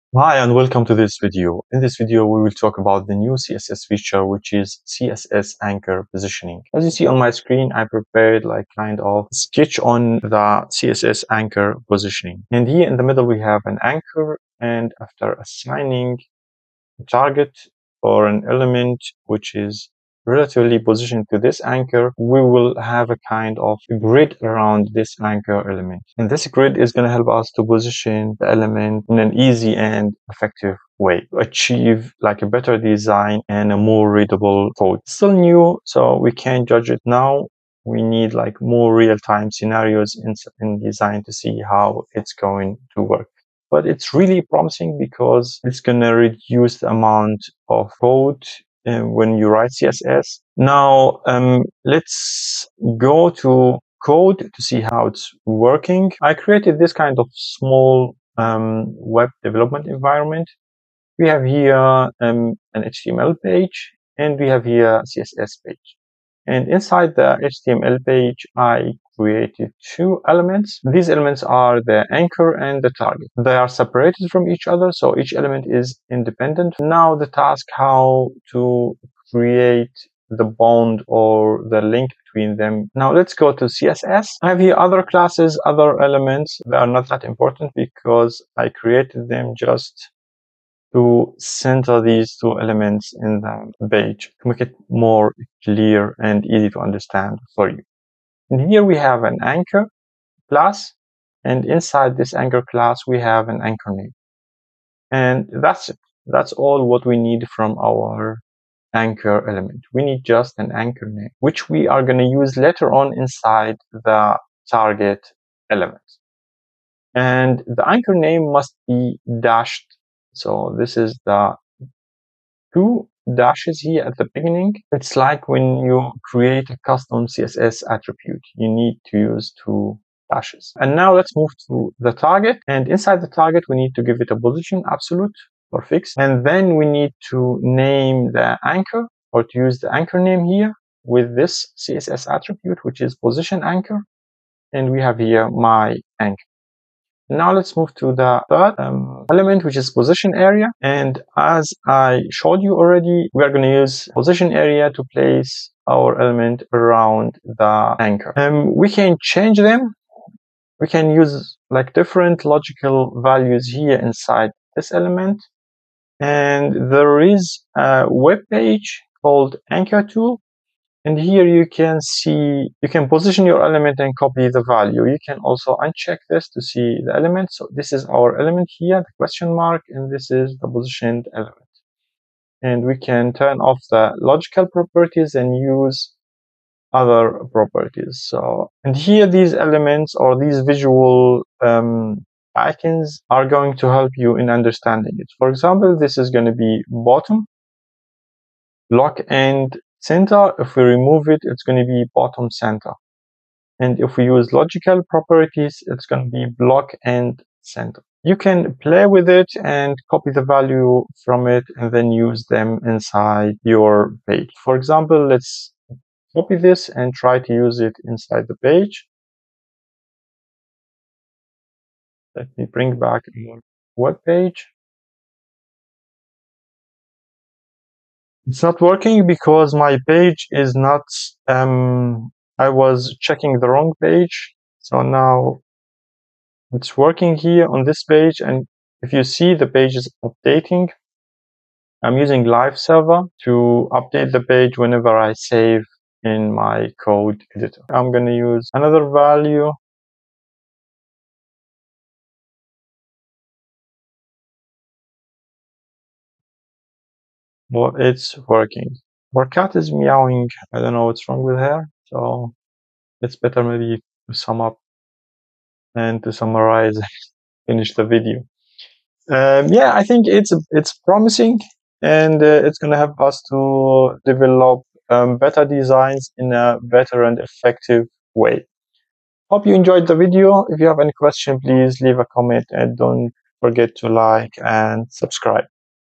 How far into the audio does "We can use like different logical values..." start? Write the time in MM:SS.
02:40.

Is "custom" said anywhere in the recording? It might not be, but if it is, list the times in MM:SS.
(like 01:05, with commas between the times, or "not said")
02:06.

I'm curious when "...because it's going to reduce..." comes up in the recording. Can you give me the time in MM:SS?
00:44.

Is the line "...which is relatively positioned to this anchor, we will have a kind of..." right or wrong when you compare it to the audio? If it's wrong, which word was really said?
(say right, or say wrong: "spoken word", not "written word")
right.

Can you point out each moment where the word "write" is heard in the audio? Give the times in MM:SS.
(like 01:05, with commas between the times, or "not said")
00:49.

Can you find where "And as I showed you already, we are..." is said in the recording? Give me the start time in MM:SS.
02:30.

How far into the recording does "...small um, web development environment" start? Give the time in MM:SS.
00:57.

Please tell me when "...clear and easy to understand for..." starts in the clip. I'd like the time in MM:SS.
01:35.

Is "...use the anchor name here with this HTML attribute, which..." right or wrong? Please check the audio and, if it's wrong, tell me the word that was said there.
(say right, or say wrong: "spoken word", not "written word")
wrong: "CSS", not "HTML".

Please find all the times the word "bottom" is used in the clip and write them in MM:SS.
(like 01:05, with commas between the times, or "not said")
03:16, 03:22.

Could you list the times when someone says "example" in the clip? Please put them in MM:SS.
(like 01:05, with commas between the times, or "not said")
03:15, 03:34.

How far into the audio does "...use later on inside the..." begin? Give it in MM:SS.
01:52.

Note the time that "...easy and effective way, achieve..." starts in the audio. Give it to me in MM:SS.
00:29.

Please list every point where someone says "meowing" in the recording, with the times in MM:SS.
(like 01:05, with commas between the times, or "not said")
04:19.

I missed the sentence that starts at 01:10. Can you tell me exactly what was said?
These elements are the anchor and the target.